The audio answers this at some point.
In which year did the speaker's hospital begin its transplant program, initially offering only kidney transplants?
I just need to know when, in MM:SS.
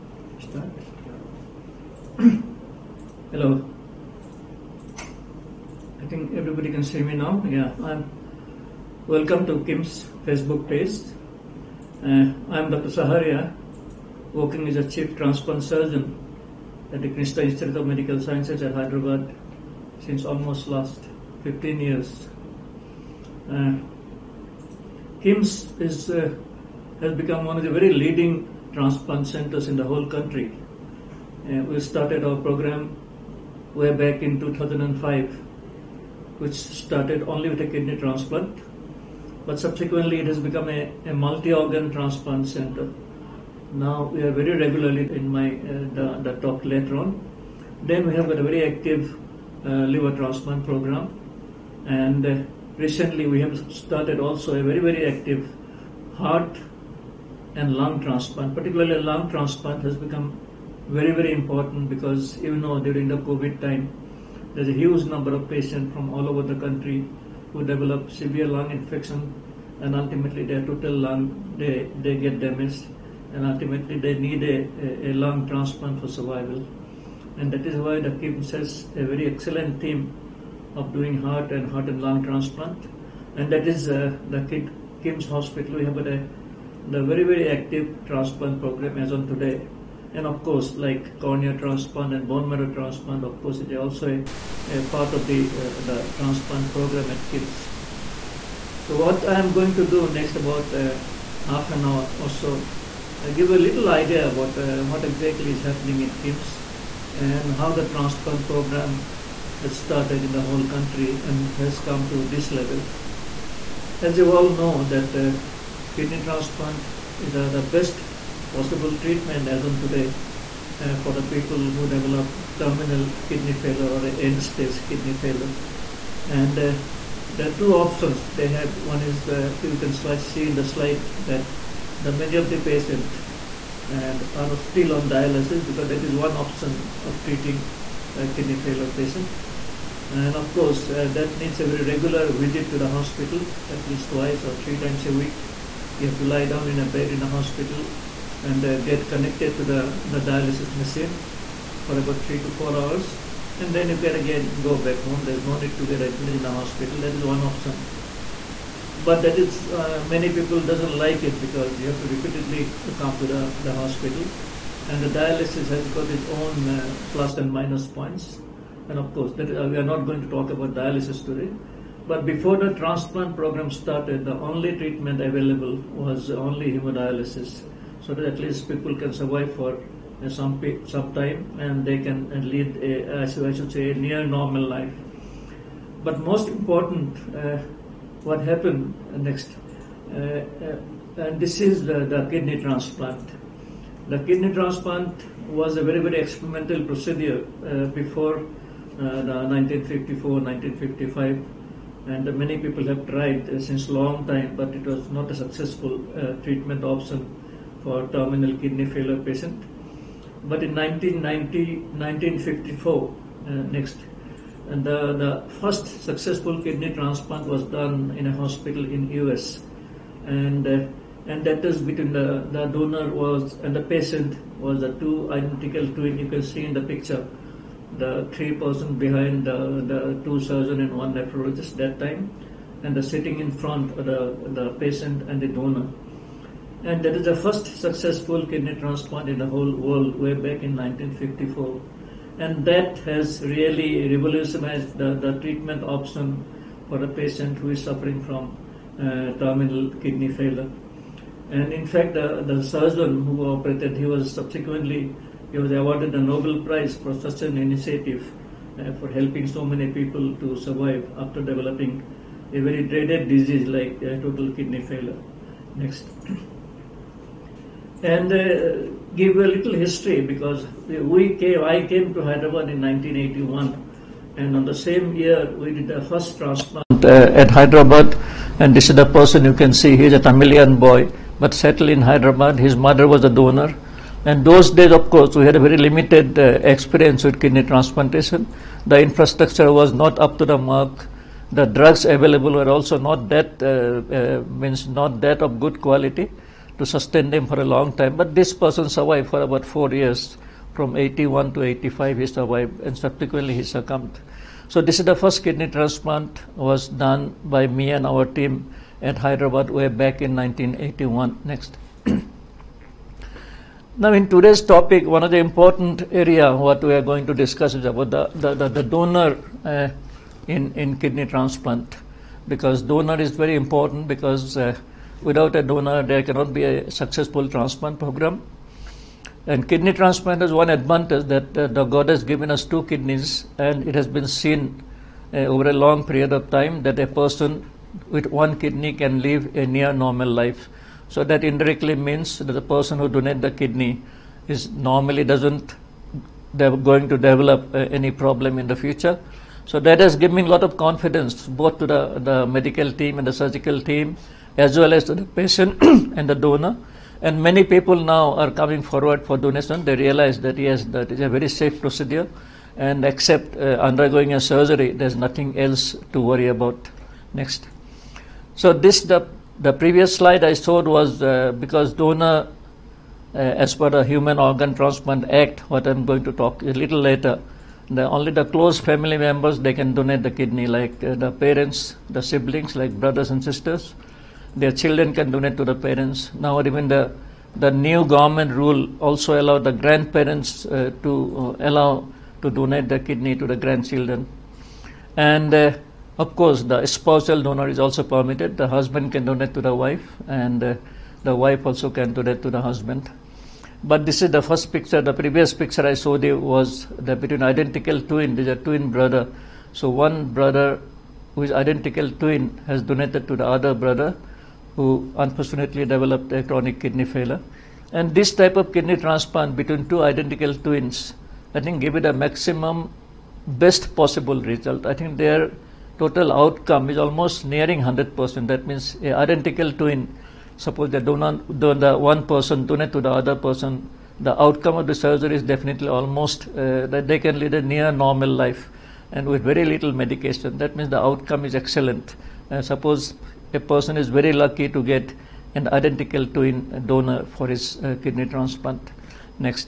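00:34.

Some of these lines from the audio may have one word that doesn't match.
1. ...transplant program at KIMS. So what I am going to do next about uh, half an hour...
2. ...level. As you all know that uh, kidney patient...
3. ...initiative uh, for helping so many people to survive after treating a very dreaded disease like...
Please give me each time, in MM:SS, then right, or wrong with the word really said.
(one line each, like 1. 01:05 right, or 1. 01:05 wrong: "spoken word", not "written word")
1. 01:36 right
2. 01:52 wrong: "transplant", not "patient"
3. 04:17 wrong: "developing", not "treating".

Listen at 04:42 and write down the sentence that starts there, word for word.
His mother was a donor and those days, of course, we had a very limited uh, experience with kidney transplantation.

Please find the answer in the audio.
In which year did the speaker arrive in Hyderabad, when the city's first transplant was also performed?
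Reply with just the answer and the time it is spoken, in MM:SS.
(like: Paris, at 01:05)
1981, at 04:32.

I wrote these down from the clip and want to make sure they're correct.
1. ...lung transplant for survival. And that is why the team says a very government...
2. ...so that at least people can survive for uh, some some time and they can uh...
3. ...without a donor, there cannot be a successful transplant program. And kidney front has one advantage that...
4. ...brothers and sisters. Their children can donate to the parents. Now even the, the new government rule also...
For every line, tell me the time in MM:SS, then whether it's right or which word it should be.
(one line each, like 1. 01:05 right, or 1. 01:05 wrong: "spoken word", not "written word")
1. 01:15 wrong: "excellent", not "government"
2. 02:58 right
3. 05:25 wrong: "transplant", not "front"
4. 06:22 right.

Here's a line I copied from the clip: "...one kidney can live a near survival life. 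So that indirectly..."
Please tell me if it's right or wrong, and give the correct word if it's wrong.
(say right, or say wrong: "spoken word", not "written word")
wrong: "normal", not "survival".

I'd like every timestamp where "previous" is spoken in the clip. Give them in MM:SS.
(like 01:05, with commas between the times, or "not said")
06:09, 06:45.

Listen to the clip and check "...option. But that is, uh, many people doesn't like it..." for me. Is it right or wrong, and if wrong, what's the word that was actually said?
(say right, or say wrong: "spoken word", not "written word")
right.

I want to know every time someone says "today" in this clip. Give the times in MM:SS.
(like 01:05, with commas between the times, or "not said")
01:29, 01:59, 02:51, 05:14.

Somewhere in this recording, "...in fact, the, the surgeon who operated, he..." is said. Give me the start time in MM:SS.
04:11.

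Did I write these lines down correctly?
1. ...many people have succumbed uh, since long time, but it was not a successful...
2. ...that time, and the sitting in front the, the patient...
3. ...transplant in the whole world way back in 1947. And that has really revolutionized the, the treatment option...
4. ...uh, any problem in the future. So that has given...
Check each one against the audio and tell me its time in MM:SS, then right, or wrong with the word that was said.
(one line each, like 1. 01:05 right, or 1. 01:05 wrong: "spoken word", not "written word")
1. 03:22 wrong: "tried", not "succumbed"
2. 03:51 right
3. 03:58 wrong: "1954", not "1947"
4. 05:47 right.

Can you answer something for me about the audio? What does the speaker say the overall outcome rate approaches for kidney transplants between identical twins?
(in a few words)
Almost 100%.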